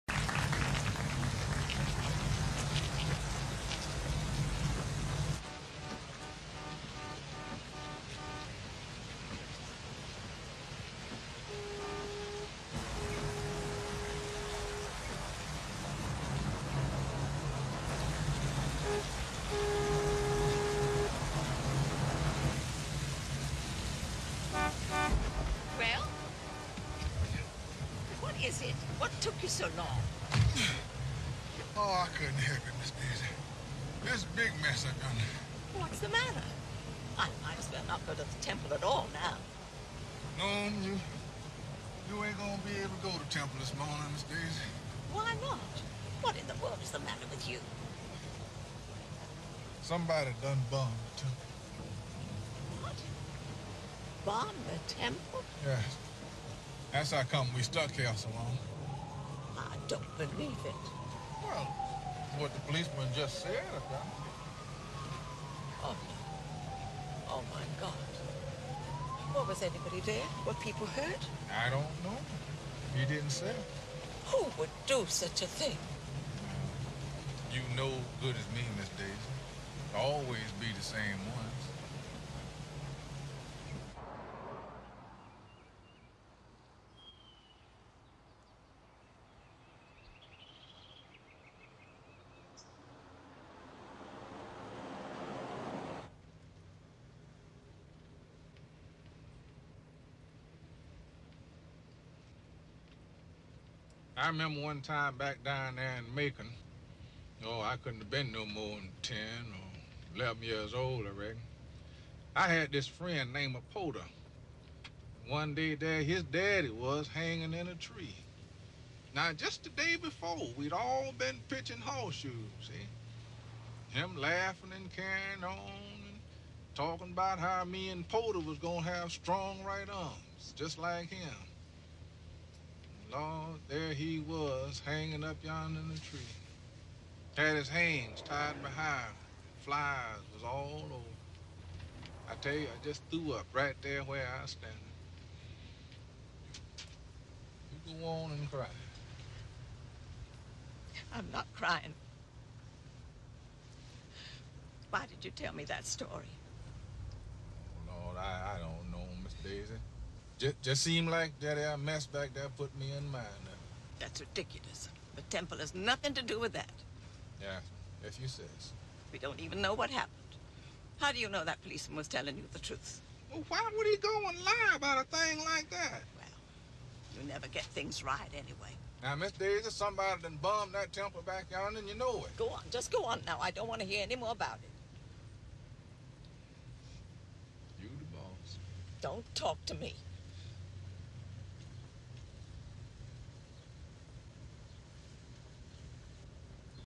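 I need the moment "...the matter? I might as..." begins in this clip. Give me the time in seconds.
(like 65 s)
35 s.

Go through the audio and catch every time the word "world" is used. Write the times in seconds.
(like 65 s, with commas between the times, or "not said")
46 s.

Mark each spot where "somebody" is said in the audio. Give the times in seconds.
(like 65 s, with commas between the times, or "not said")
49 s, 179 s.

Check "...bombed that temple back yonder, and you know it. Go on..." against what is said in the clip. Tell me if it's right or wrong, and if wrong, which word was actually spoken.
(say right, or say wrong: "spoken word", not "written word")
right.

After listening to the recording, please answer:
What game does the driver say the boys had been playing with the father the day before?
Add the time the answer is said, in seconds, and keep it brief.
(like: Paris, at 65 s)
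pitching horseshoes, at 121 s.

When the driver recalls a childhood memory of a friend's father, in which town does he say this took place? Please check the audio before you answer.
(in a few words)
Macon.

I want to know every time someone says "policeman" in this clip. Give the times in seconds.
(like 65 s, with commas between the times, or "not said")
62 s, 171 s.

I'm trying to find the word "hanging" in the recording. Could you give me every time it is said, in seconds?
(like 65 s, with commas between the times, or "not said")
117 s, 134 s.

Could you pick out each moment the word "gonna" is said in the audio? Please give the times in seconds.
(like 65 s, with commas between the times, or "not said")
42 s, 128 s.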